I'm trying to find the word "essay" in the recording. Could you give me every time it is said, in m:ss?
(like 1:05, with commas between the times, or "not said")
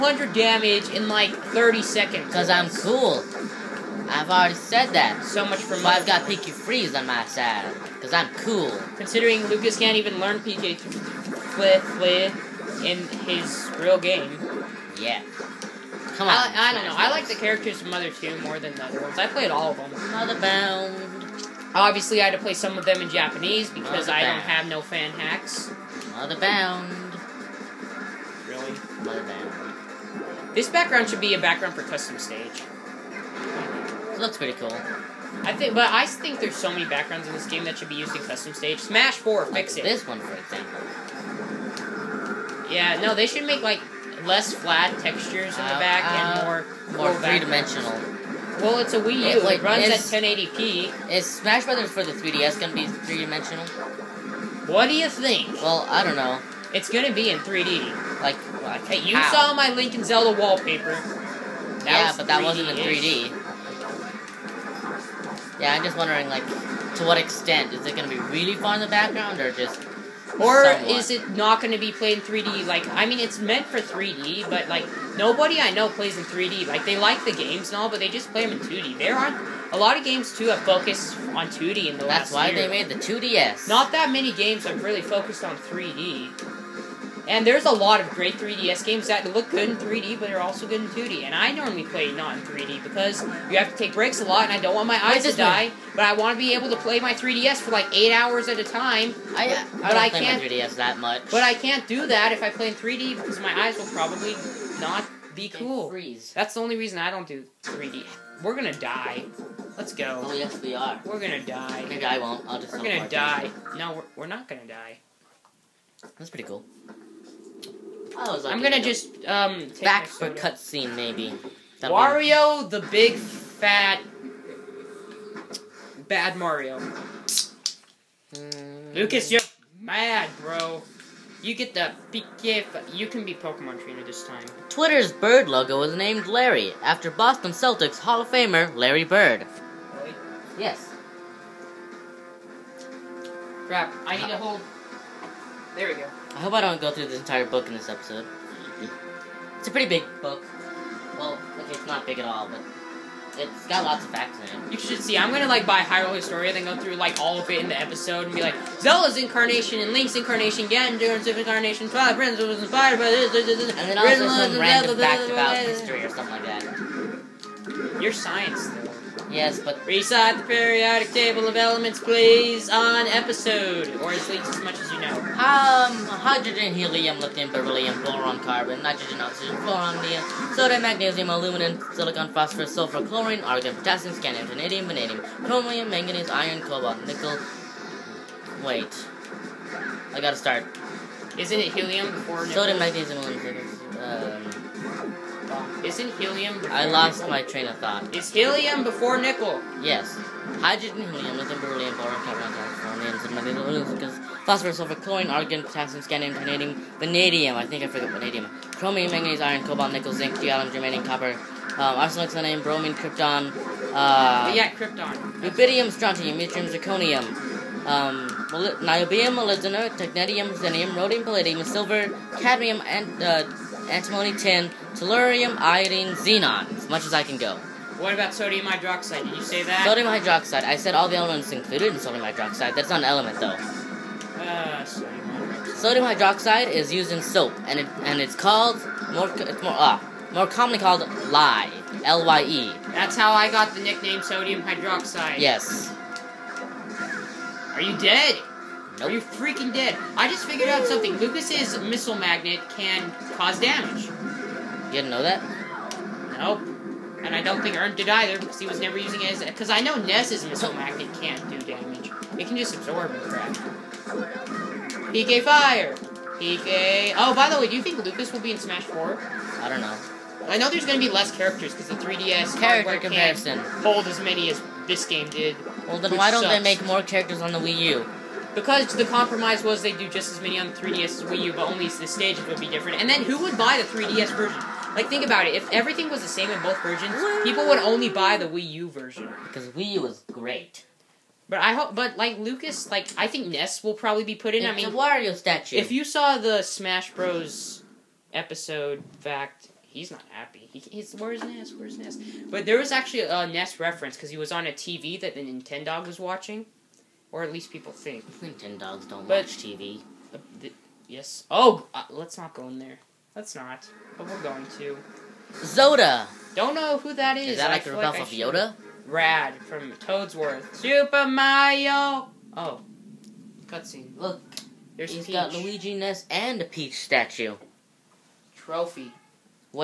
not said.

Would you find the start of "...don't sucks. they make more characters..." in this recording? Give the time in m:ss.
4:36.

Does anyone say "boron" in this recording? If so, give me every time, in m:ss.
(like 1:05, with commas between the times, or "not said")
2:58, 3:21.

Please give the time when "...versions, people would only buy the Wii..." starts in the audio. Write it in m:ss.
4:46.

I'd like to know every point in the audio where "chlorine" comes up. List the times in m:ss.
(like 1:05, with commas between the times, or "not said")
3:03, 3:24.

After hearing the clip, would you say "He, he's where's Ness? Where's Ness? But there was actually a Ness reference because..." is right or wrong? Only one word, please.
right.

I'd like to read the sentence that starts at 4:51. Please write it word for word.
But I hope, but like Lucas, like I think Ness will probably be put in.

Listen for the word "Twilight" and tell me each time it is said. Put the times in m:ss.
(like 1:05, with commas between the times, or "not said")
2:41.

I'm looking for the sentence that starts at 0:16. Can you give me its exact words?
I like the characters from Mother 2 more than the other ones.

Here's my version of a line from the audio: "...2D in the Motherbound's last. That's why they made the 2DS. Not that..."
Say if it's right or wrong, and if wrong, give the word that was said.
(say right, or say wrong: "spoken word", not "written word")
wrong: "That", not "Motherbound".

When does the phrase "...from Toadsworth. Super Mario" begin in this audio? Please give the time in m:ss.
5:19.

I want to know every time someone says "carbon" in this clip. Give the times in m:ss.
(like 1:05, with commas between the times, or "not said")
2:58, 3:22.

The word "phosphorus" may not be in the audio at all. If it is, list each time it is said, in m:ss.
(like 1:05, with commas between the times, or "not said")
3:02, 3:24.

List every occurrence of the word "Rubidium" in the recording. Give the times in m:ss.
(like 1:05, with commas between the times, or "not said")
3:35.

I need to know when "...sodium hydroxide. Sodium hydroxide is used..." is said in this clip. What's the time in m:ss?
3:54.